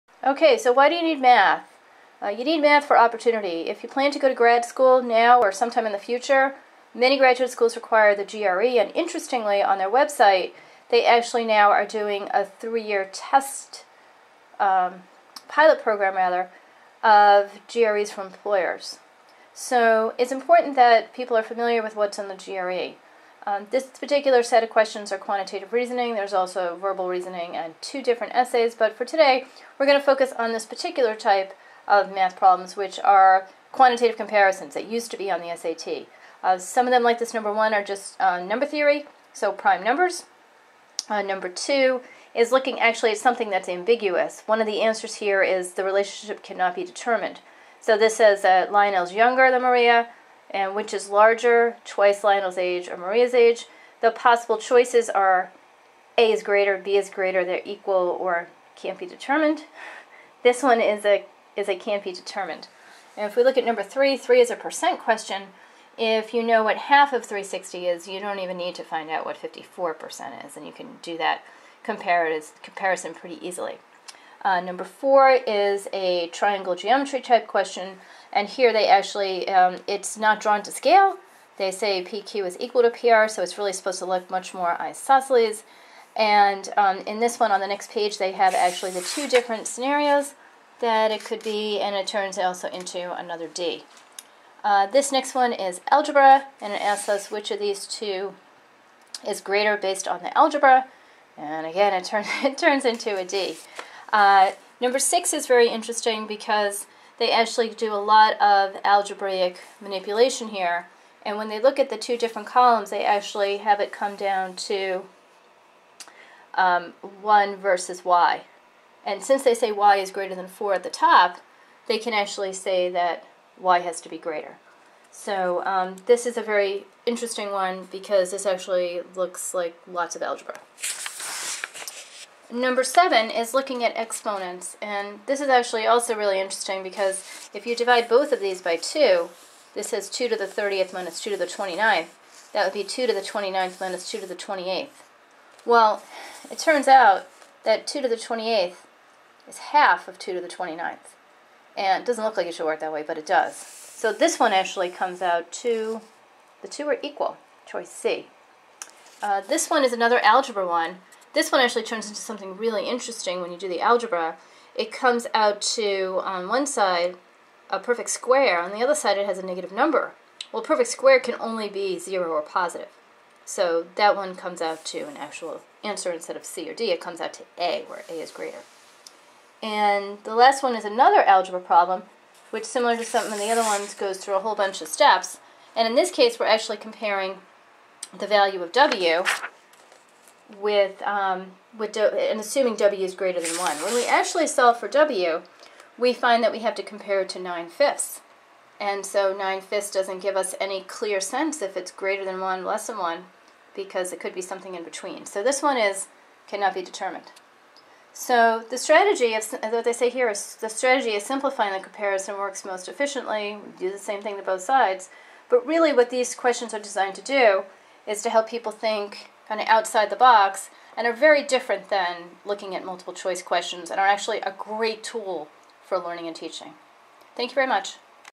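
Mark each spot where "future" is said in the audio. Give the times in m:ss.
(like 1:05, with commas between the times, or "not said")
0:05.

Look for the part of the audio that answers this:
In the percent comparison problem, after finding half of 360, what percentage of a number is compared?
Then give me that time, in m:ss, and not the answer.
1:09.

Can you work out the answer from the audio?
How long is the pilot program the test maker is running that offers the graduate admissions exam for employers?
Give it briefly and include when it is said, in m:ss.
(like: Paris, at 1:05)
3 years, at 0:12.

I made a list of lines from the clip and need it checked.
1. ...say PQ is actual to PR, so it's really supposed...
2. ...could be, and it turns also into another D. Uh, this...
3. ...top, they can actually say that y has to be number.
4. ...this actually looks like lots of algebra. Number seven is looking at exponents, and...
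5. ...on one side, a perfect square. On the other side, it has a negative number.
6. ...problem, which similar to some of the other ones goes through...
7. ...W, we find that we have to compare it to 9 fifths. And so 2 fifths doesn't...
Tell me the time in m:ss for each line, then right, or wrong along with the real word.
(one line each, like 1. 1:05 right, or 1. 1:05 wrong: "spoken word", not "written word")
1. 1:21 wrong: "equal", not "actual"
2. 1:31 right
3. 2:00 wrong: "greater", not "number"
4. 2:08 right
5. 2:46 right
6. 3:01 right
7. 3:14 wrong: "9", not "2".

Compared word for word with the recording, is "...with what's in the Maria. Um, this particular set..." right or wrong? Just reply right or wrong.
wrong.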